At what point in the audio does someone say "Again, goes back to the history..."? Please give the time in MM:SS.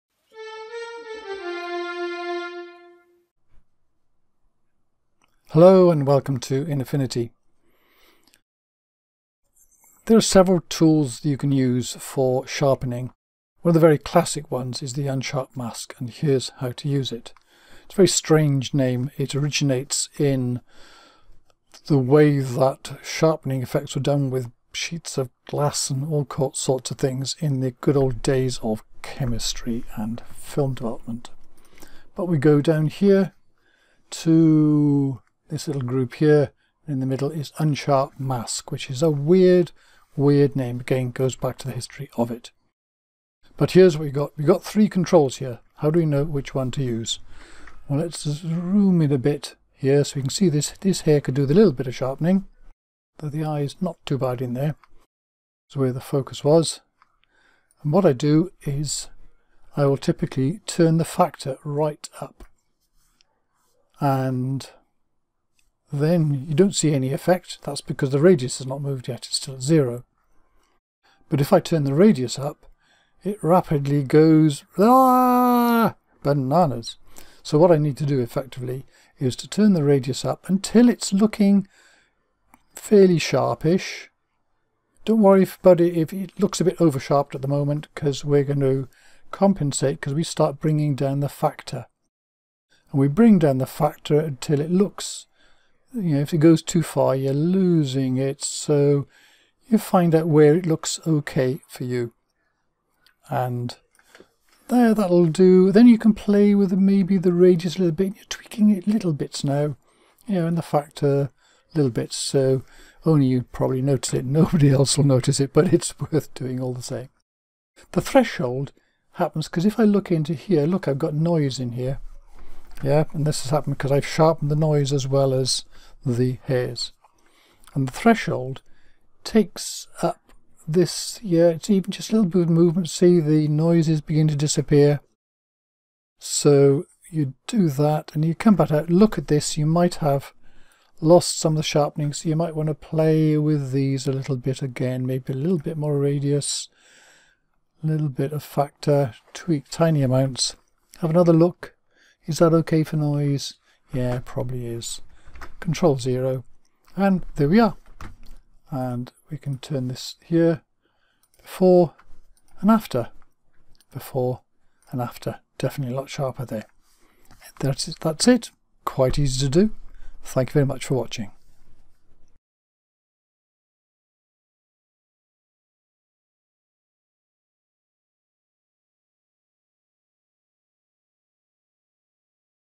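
00:40.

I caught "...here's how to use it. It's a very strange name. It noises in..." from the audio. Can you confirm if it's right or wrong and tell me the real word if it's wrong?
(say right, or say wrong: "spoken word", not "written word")
wrong: "originates", not "noises".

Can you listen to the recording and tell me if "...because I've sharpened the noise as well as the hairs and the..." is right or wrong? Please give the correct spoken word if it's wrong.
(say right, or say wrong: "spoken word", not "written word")
right.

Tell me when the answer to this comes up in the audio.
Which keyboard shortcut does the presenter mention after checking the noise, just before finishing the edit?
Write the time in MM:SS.
02:35.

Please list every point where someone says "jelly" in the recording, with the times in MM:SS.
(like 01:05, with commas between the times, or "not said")
not said.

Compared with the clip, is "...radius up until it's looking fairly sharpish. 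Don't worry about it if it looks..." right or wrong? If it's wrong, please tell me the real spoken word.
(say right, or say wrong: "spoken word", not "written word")
right.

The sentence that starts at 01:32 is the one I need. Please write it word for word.
And we bring down the factor until it looks you know, if it goes too far, you're losing it.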